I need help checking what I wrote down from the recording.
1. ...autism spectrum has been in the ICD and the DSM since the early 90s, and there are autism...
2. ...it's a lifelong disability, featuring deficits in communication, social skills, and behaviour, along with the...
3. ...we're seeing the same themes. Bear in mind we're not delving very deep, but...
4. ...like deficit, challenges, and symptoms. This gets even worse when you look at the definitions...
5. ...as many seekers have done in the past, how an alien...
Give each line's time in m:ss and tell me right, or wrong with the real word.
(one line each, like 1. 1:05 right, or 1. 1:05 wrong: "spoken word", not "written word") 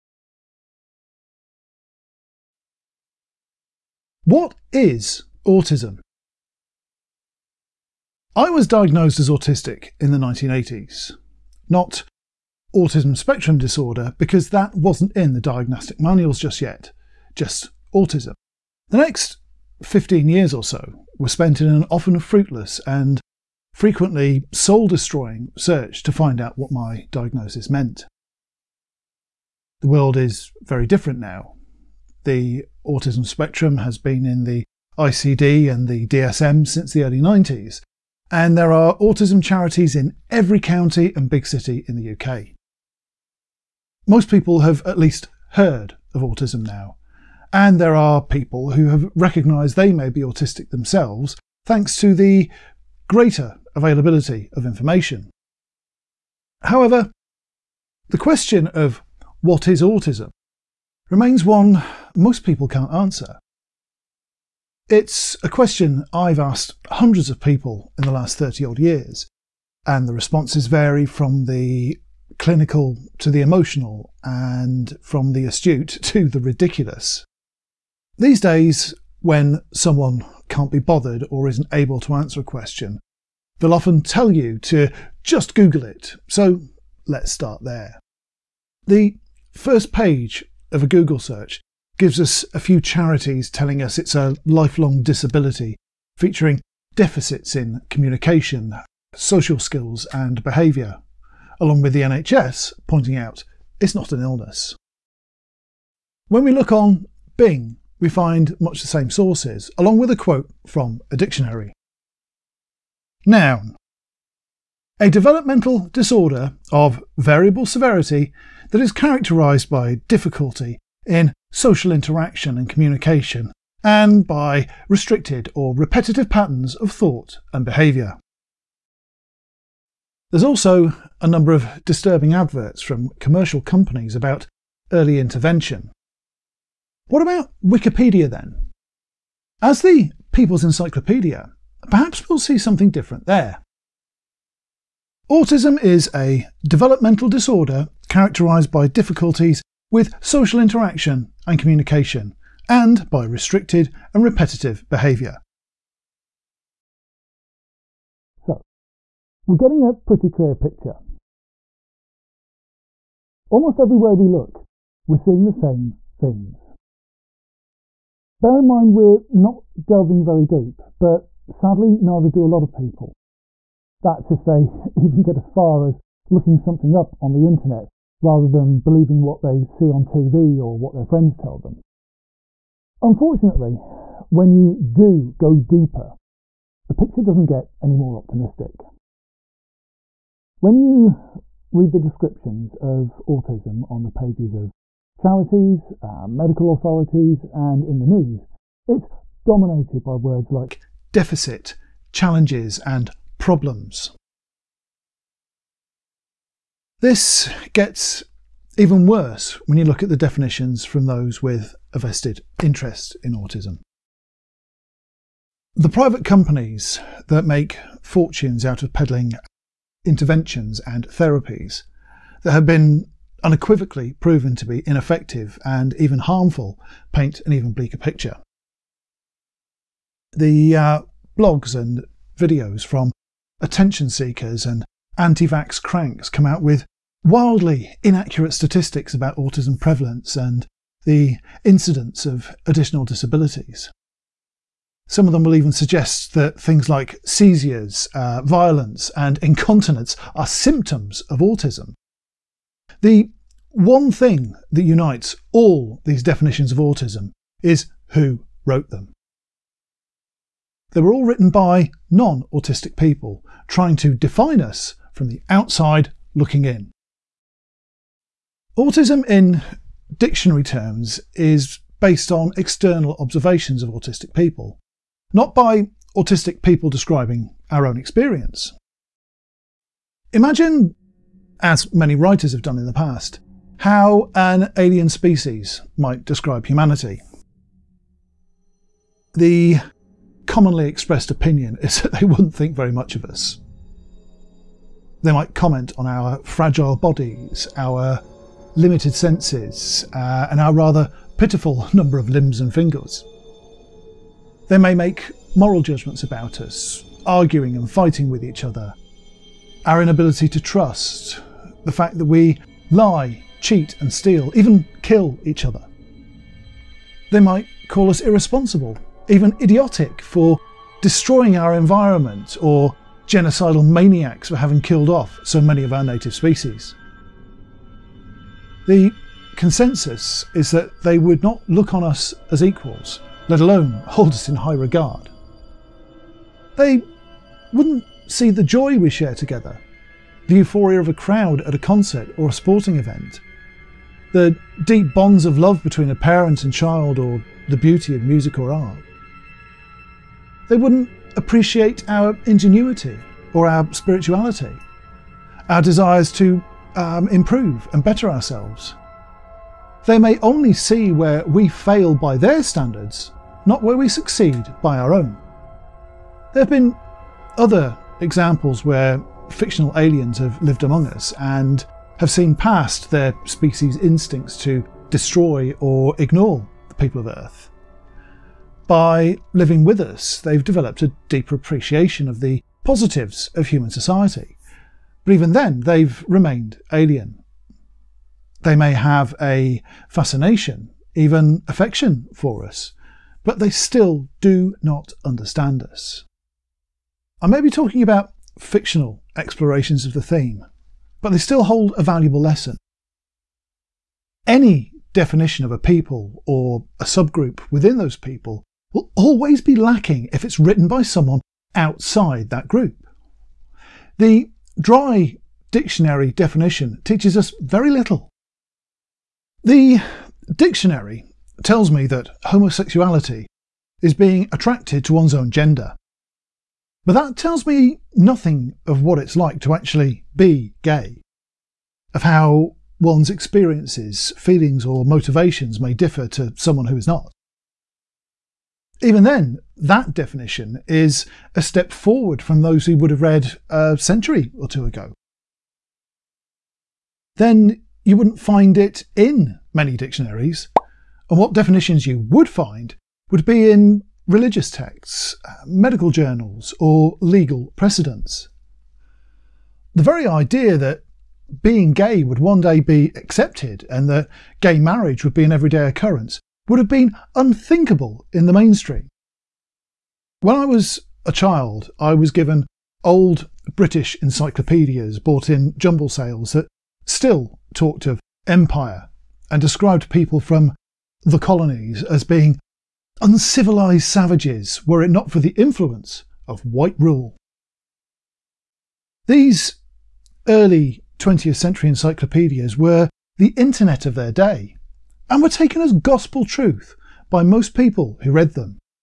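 1. 0:32 right
2. 1:33 right
3. 2:45 right
4. 3:20 wrong: "problems", not "symptoms"
5. 4:41 wrong: "writers", not "seekers".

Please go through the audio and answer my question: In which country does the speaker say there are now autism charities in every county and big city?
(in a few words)
UK.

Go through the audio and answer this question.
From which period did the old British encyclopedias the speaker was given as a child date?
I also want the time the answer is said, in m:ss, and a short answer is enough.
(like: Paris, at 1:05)
Early 20th century, at 8:10.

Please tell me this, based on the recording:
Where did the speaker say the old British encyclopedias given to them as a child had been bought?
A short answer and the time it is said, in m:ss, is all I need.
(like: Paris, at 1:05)
Jumble sales, at 7:55.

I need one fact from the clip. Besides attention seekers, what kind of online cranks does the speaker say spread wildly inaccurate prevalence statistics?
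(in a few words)
Anti vax cranks.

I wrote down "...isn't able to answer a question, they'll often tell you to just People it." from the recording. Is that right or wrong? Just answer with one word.
wrong.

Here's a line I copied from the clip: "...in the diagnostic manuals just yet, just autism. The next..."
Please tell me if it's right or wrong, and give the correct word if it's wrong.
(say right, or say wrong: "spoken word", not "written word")
right.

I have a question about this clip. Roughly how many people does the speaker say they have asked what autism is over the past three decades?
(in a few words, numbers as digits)
Hundreds.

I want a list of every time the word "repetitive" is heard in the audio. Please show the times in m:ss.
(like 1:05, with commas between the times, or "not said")
2:05, 2:34.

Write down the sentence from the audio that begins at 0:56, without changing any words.
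However, the question of what is autism remains one most people can't answer.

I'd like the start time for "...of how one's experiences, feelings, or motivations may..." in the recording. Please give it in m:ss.
7:12.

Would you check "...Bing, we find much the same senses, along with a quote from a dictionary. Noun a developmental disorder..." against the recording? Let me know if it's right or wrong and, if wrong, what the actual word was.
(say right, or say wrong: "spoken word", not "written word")
wrong: "sources", not "senses".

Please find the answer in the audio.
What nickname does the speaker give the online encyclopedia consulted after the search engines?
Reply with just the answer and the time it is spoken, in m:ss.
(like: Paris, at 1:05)
The People's Encyclopedia, at 2:20.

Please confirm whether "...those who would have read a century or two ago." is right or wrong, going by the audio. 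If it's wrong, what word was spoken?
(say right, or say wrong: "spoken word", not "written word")
right.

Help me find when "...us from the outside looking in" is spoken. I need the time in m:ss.
4:24.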